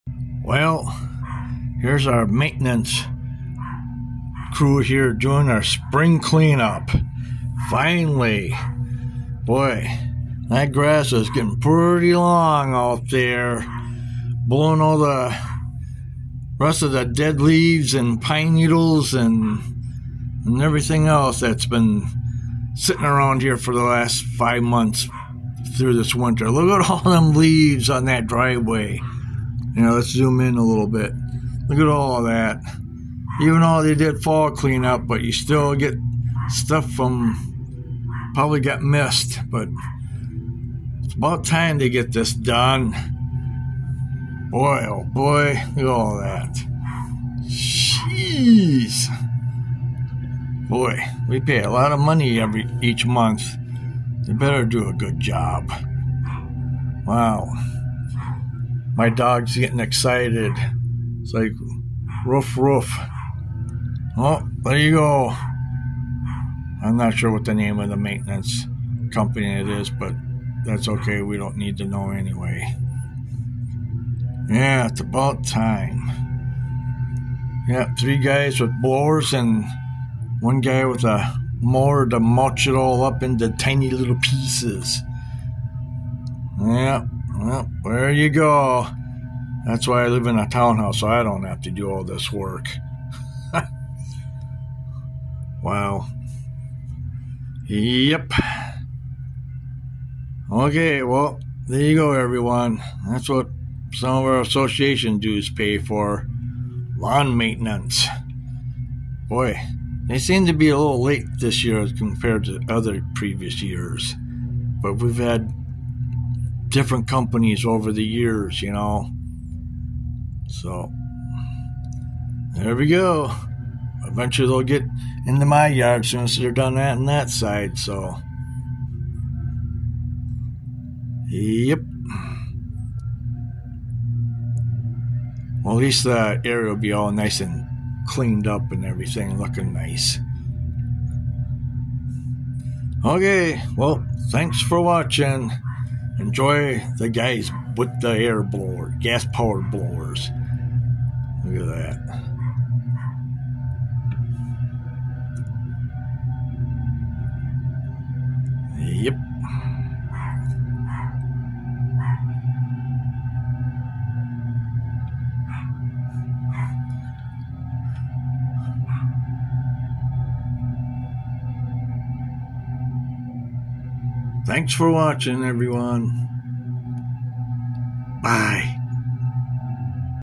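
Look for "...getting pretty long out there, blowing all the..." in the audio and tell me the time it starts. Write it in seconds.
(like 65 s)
11 s.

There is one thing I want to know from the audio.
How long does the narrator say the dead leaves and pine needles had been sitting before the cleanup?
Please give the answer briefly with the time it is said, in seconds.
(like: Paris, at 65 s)
5 months, at 24 s.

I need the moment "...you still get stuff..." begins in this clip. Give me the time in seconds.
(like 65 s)
35 s.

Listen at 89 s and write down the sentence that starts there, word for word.
That's why I live in a townhouse, so I don't have to do all this work.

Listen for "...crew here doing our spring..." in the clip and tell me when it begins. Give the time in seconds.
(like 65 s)
4 s.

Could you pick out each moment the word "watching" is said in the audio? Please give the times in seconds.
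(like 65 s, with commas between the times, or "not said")
144 s, 174 s.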